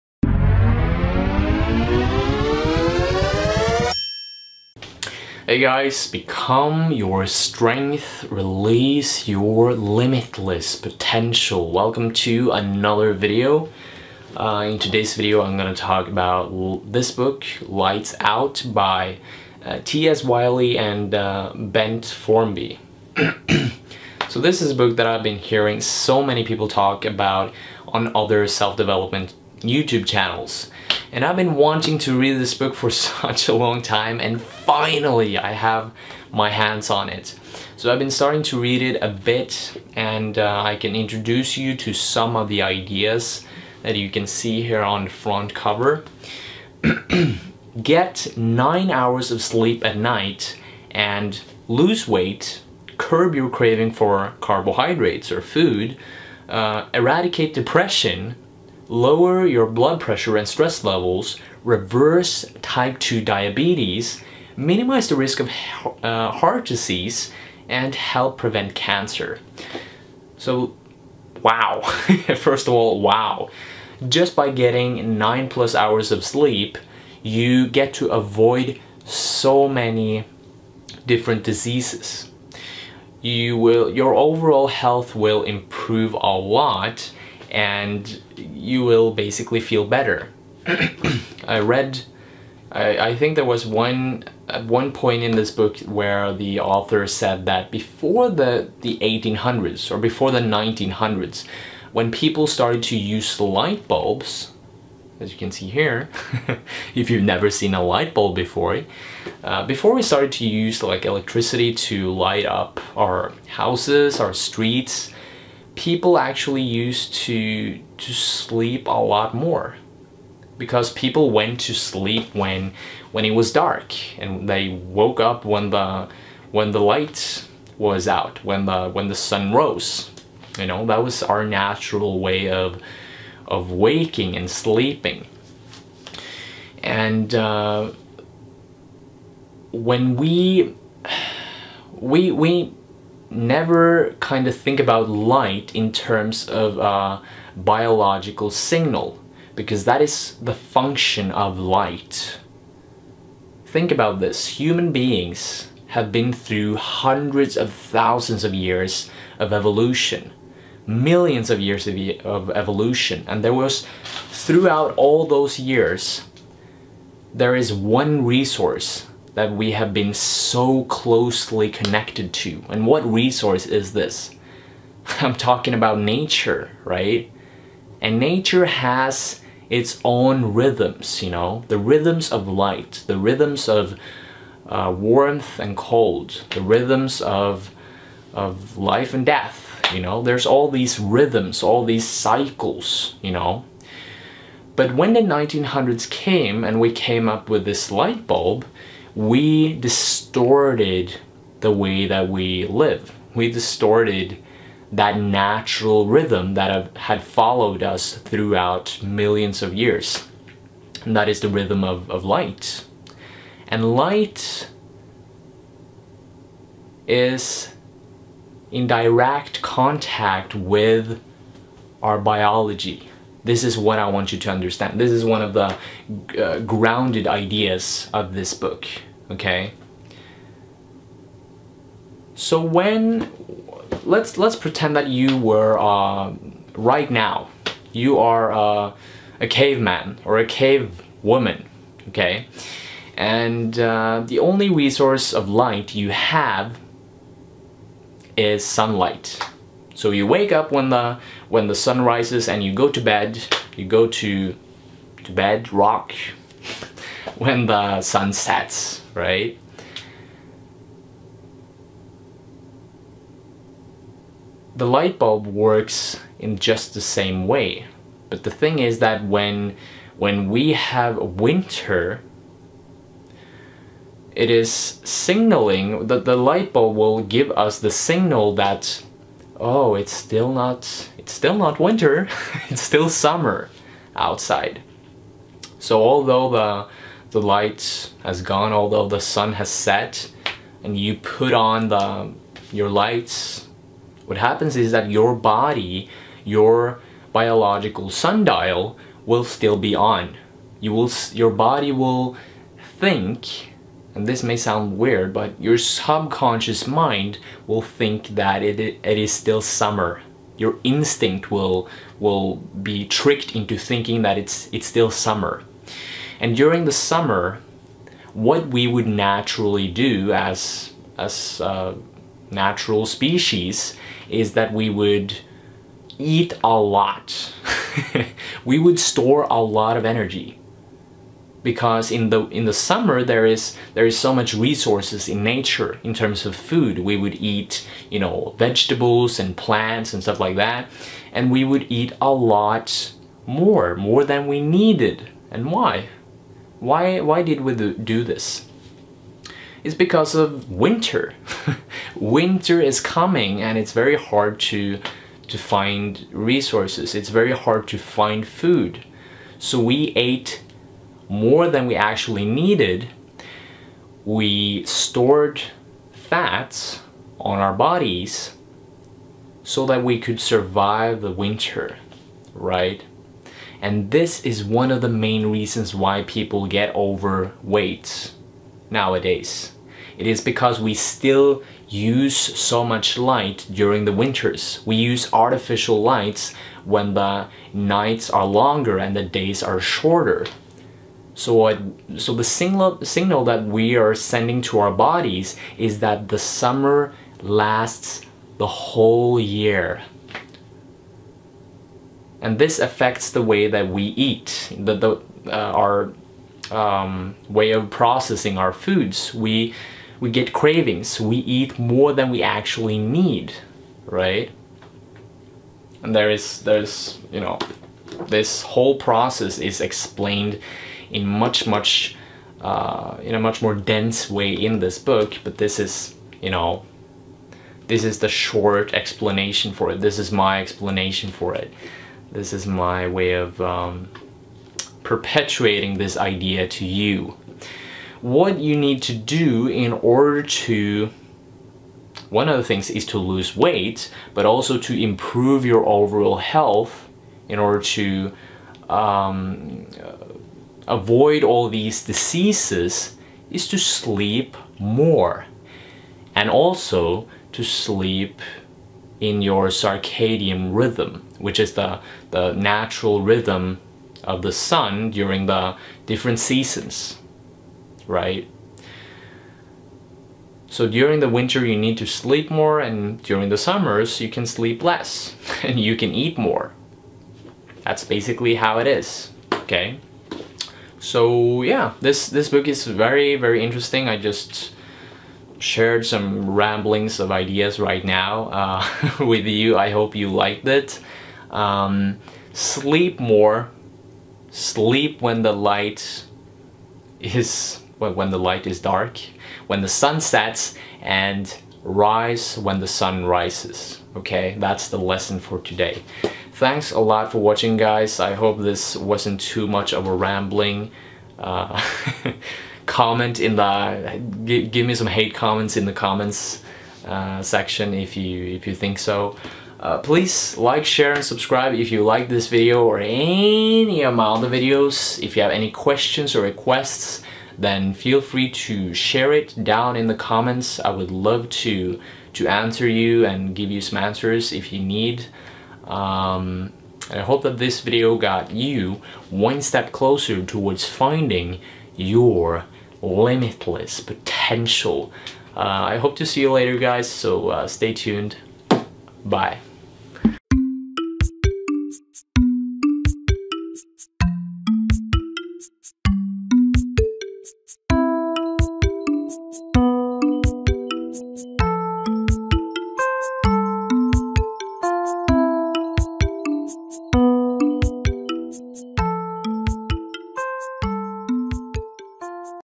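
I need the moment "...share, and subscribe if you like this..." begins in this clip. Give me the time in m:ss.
8:40.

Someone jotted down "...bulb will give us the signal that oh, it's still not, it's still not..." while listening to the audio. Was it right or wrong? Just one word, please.
right.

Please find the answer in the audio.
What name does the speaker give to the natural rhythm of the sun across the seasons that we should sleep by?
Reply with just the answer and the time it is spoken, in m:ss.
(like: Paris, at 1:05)
Circadian rhythm, at 7:39.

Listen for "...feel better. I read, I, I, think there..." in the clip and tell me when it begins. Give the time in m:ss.
1:29.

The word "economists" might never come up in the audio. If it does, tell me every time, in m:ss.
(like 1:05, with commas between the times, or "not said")
not said.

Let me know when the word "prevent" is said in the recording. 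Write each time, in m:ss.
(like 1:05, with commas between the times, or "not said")
1:08.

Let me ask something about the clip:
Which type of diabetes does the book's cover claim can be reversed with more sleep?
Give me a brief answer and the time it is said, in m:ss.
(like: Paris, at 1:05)
Type 2, at 1:02.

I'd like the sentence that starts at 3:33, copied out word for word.
And light is in direct contact with our biology, this is what I want you to understand.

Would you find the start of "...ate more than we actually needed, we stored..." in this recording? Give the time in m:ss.
6:00.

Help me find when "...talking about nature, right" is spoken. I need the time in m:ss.
2:55.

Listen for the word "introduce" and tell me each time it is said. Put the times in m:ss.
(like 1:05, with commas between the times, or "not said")
0:40.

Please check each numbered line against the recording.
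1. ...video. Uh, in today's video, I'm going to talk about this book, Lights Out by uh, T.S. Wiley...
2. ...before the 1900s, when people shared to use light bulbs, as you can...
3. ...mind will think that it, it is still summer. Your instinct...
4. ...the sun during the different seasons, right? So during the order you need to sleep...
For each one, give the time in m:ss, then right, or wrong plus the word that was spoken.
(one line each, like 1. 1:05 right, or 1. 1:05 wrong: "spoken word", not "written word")
1. 0:13 right
2. 1:39 wrong: "started", not "shared"
3. 5:06 right
4. 7:44 wrong: "winter", not "order".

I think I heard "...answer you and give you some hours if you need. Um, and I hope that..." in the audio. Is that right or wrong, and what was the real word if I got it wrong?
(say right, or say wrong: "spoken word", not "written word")
wrong: "answers", not "hours".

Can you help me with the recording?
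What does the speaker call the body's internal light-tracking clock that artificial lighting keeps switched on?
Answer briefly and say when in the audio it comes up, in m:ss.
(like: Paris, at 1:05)
Biological sundial, at 4:57.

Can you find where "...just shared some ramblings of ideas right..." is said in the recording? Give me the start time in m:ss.
8:04.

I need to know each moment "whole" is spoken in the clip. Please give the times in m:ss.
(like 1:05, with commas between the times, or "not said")
6:38, 6:58.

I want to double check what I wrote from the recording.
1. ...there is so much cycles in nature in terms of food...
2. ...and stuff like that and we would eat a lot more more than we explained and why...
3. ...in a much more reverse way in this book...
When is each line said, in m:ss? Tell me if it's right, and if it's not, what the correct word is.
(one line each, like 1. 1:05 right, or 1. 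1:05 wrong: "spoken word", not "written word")
1. 5:33 wrong: "resources", not "cycles"
2. 5:40 wrong: "needed", not "explained"
3. 7:03 wrong: "dense", not "reverse".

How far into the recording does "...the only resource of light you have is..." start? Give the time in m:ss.
4:04.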